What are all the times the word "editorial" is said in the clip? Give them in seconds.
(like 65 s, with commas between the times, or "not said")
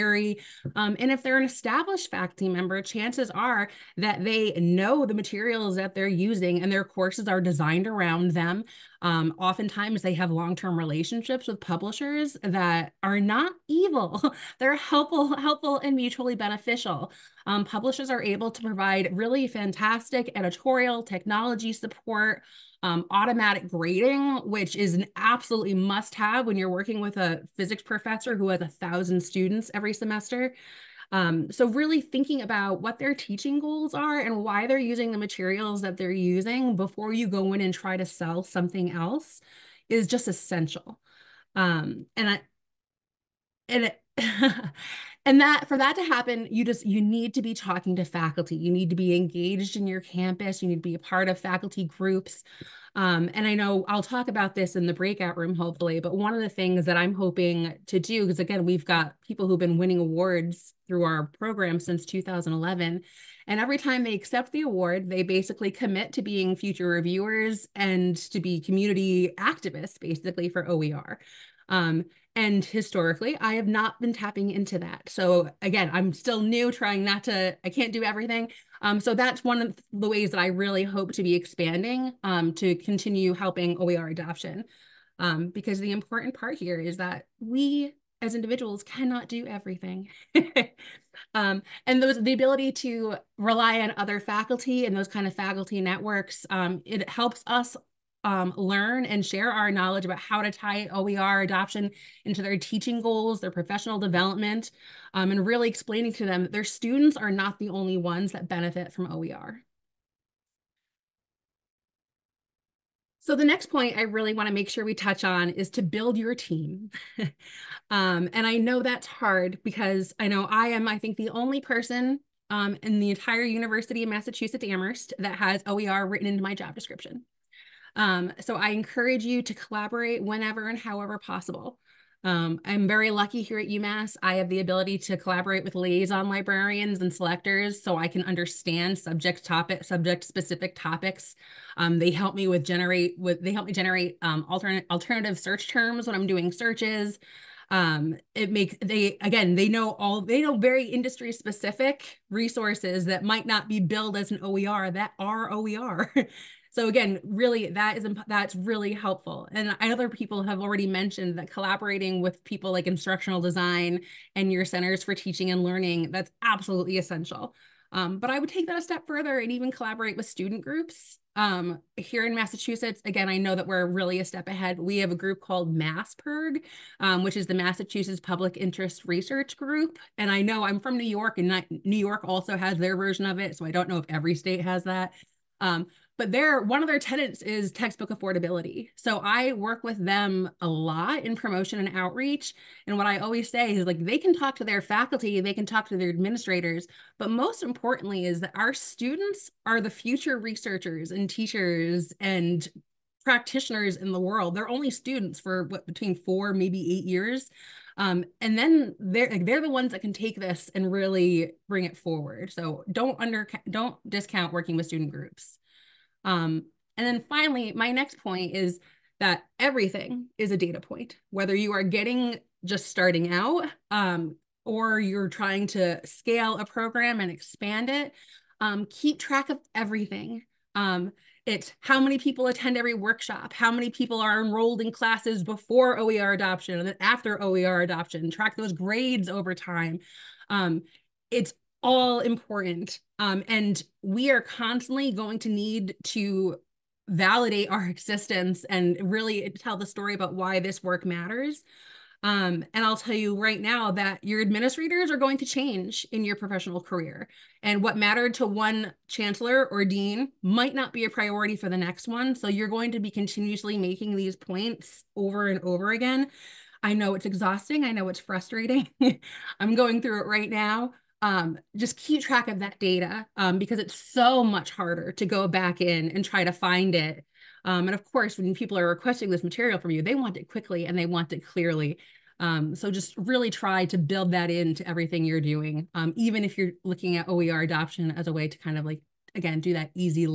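20 s.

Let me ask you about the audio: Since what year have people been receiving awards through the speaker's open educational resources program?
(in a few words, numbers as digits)
2011.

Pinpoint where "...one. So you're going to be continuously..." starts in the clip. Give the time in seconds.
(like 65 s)
262 s.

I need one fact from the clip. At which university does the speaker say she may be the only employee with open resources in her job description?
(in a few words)
University of Massachusetts Amherst.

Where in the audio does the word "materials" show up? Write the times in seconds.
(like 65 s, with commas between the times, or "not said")
5 s, 35 s, 279 s.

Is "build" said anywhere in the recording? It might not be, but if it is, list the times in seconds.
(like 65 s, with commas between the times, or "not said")
115 s, 283 s.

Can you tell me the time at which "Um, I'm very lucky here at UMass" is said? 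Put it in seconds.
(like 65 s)
132 s.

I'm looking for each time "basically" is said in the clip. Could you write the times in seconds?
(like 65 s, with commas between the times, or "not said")
65 s, 69 s.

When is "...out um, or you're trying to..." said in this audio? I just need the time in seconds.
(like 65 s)
223 s.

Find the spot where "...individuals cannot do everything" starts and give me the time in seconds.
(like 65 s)
88 s.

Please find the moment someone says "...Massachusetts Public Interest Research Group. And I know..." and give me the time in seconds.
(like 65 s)
177 s.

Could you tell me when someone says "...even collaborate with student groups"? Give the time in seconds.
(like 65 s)
169 s.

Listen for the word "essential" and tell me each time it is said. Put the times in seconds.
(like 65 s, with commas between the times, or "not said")
40 s, 166 s.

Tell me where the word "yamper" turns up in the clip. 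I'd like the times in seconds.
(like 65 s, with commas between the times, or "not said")
not said.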